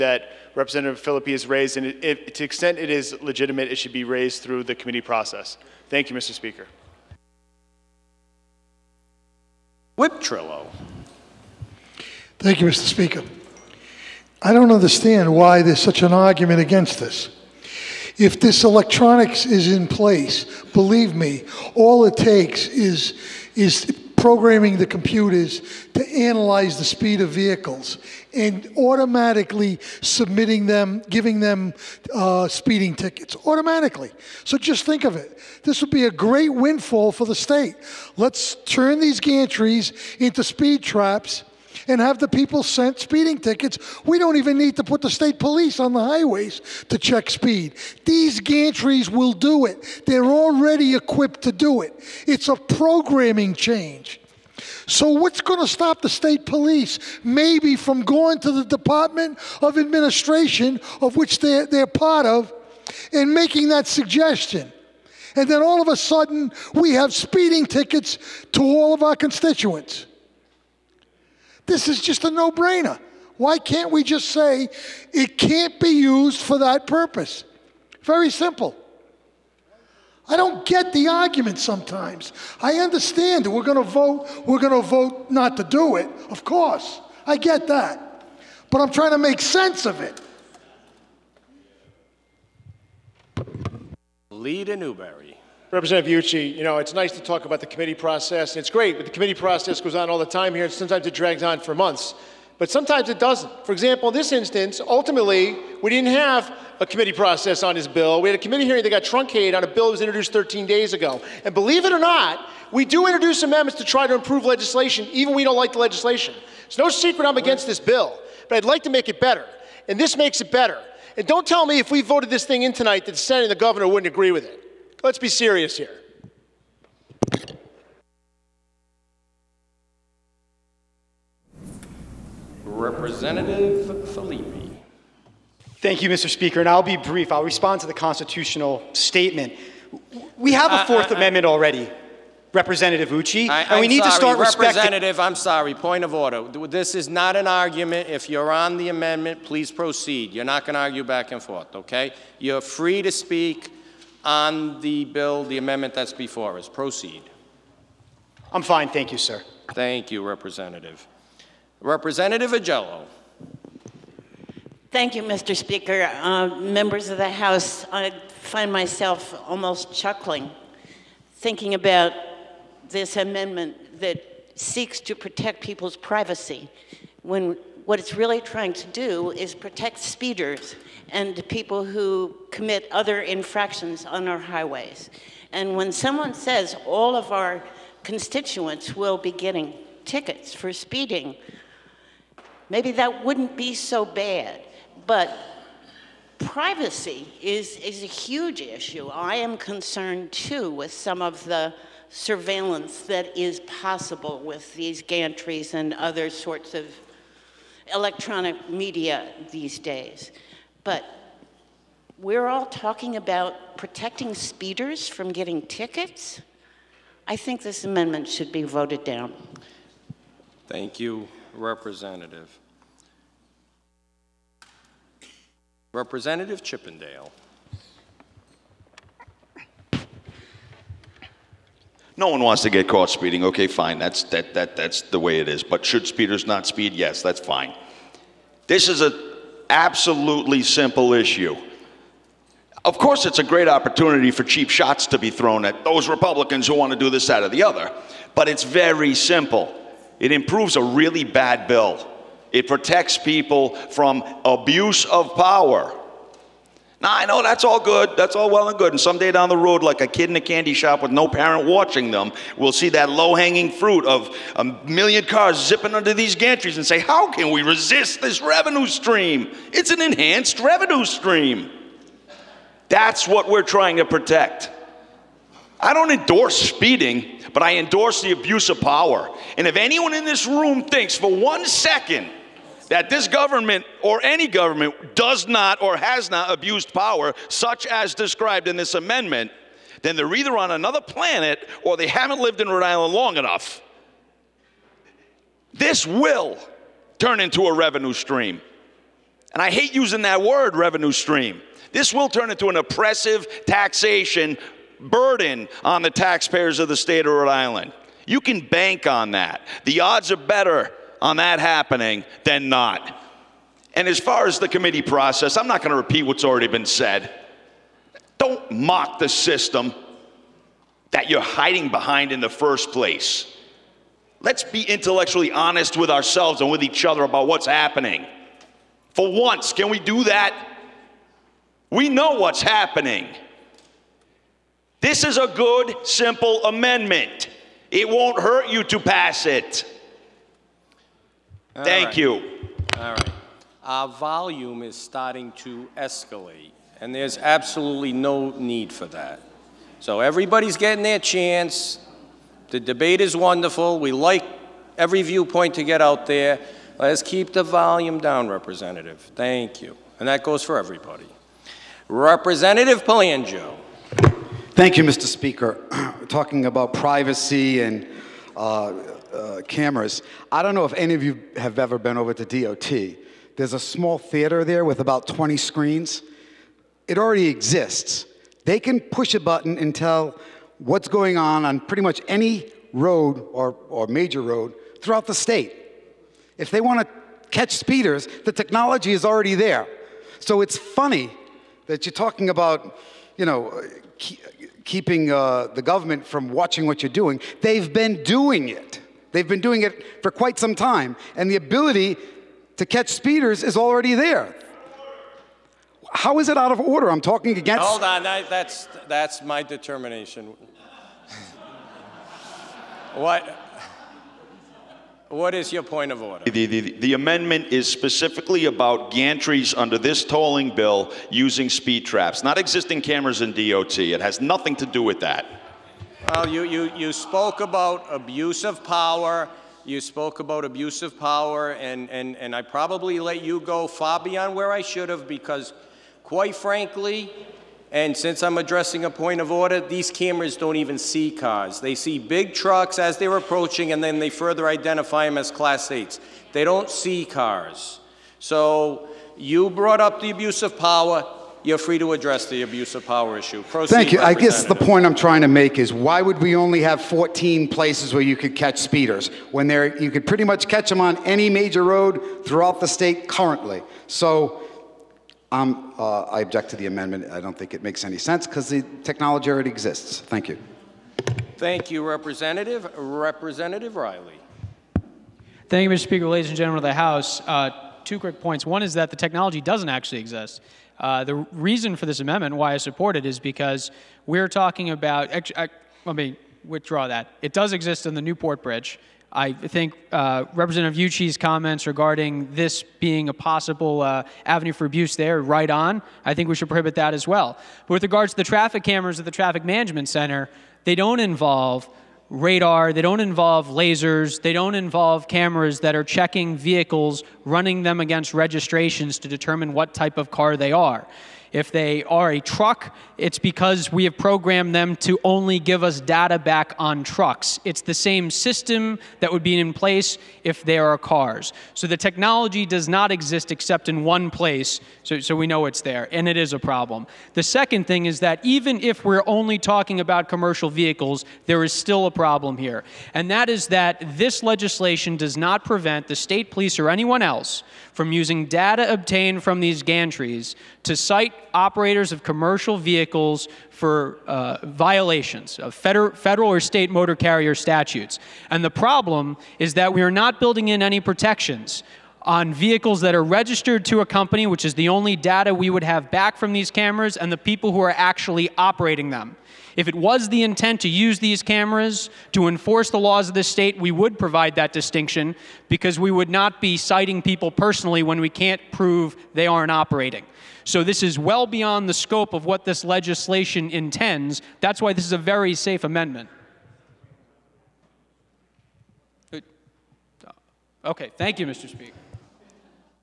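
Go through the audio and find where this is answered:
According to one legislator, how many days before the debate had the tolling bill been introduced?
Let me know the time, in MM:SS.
01:50.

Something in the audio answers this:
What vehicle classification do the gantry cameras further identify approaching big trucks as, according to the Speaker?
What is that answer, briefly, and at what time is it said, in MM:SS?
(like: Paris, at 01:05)
Class 8, at 07:25.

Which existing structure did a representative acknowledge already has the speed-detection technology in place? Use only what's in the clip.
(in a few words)
Newport Bridge.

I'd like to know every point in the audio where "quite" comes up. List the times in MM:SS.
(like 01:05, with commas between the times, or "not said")
06:40, 07:16.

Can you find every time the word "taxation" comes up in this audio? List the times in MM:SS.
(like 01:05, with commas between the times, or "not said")
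05:03.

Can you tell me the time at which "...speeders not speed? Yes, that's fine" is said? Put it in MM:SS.
03:56.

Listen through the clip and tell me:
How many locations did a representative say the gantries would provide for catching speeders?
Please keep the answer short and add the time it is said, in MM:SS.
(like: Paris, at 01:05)
14, at 07:37.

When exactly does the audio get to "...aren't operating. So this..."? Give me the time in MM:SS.
09:29.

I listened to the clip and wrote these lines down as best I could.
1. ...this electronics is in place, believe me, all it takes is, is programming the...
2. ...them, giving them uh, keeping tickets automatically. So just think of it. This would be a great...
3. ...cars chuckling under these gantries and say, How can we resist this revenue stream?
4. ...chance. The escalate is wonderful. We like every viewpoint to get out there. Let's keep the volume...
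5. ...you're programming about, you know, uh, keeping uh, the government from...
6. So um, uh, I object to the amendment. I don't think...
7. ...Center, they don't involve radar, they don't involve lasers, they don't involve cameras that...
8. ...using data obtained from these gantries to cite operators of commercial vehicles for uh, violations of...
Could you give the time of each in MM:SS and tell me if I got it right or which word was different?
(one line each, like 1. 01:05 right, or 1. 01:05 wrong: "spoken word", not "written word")
1. 00:18 right
2. 00:30 wrong: "speeding", not "keeping"
3. 04:25 wrong: "zipping", not "chuckling"
4. 05:51 wrong: "debate", not "escalate"
5. 06:32 wrong: "talking", not "programming"
6. 07:44 right
7. 08:20 right
8. 08:58 right.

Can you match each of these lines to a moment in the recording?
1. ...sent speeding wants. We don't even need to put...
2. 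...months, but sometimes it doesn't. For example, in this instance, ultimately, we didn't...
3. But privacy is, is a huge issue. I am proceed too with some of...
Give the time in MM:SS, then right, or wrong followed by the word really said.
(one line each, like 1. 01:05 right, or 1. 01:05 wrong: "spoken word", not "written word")
1. 00:42 wrong: "tickets", not "wants"
2. 01:41 right
3. 03:15 wrong: "concerned", not "proceed".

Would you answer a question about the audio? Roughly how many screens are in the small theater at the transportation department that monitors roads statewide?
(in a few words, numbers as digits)
20.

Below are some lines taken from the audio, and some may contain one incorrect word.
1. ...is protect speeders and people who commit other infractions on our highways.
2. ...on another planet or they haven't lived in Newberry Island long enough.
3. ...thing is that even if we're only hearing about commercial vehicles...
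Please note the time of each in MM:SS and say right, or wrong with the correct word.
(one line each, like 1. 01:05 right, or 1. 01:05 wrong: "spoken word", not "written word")
1. 02:59 right
2. 04:50 wrong: "Rhode", not "Newberry"
3. 08:47 wrong: "talking", not "hearing".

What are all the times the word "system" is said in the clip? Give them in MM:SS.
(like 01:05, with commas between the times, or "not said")
05:19, 08:38.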